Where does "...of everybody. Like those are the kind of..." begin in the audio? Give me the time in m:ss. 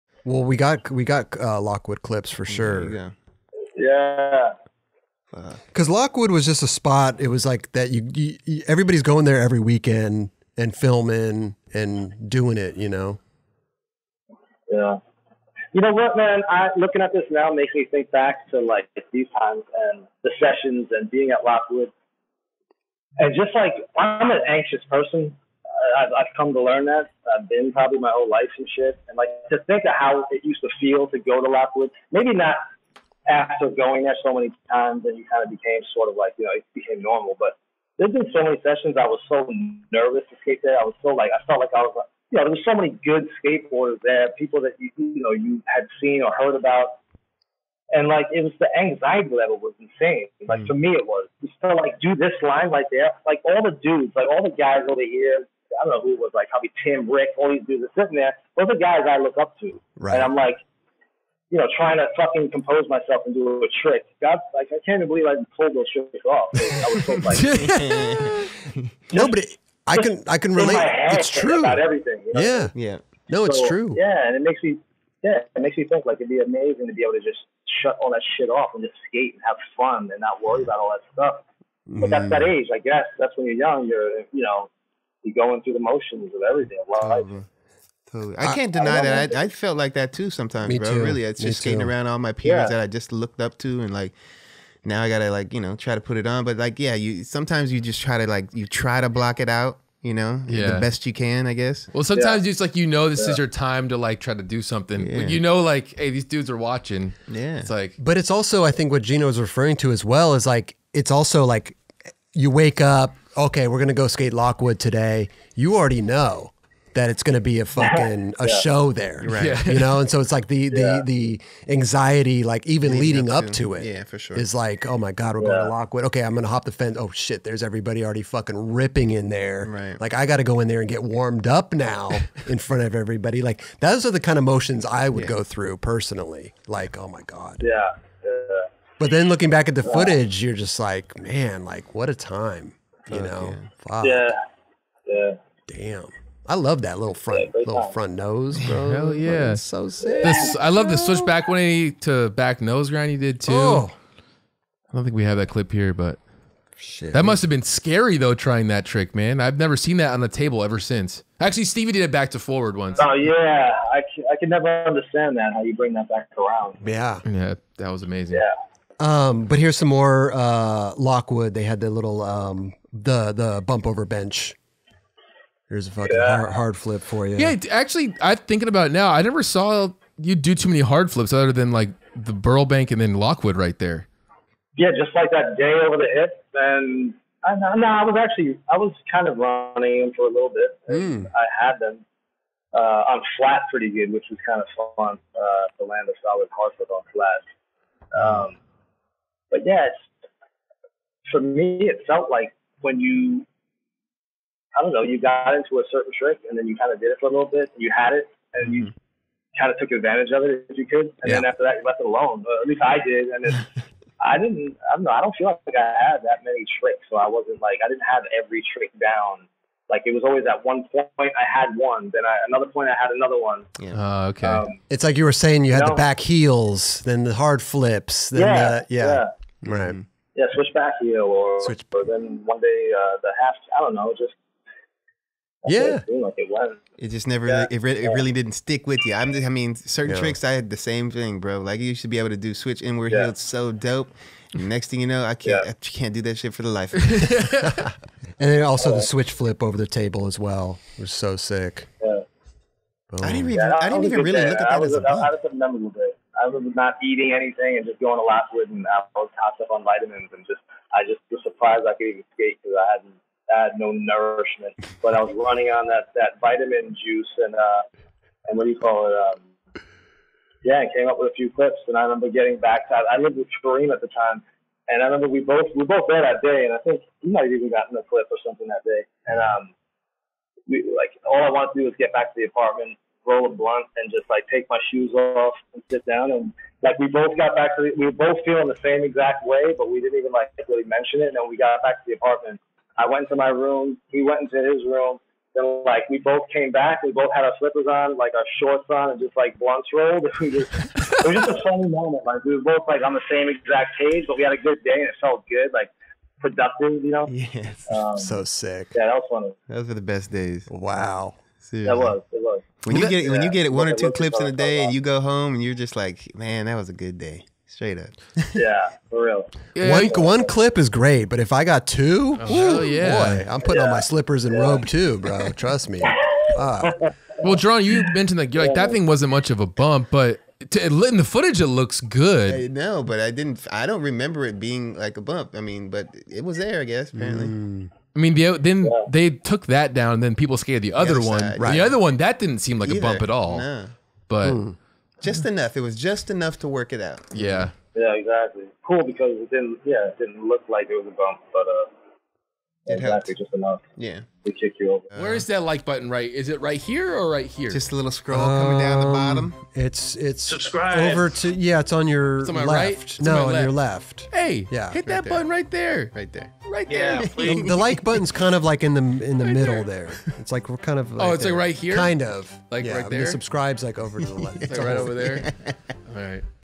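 2:12.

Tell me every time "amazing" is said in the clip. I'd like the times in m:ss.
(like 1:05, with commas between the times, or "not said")
1:16, 2:48.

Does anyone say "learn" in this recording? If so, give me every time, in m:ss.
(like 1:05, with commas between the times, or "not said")
0:26.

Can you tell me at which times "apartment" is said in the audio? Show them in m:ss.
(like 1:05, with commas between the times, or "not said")
4:42, 4:52.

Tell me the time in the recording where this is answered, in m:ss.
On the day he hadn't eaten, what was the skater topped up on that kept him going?
4:19.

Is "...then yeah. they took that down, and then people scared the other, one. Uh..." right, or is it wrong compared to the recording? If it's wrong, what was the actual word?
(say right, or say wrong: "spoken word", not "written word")
right.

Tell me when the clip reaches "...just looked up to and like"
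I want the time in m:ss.
1:32.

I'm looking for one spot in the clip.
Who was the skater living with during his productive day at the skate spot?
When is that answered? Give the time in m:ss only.
4:33.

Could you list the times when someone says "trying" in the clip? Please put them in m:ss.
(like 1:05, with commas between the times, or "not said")
1:01, 2:38.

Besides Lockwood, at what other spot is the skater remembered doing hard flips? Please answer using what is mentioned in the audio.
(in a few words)
Burbank.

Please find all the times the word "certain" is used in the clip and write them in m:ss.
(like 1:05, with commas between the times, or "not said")
3:25, 3:59.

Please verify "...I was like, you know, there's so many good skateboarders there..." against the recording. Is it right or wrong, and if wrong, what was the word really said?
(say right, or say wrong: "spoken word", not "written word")
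right.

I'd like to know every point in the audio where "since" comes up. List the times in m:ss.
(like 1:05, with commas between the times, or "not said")
2:40.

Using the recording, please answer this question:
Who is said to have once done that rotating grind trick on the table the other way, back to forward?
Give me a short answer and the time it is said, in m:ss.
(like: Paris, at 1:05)
Stevie, at 2:41.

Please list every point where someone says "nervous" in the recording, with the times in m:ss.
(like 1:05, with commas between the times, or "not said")
0:39.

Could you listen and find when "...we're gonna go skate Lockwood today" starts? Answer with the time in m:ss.
1:53.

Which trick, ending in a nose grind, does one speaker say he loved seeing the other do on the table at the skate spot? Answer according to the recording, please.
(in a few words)
switchback 180 to back nose grind.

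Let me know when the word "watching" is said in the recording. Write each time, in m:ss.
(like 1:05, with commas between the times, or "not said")
1:46.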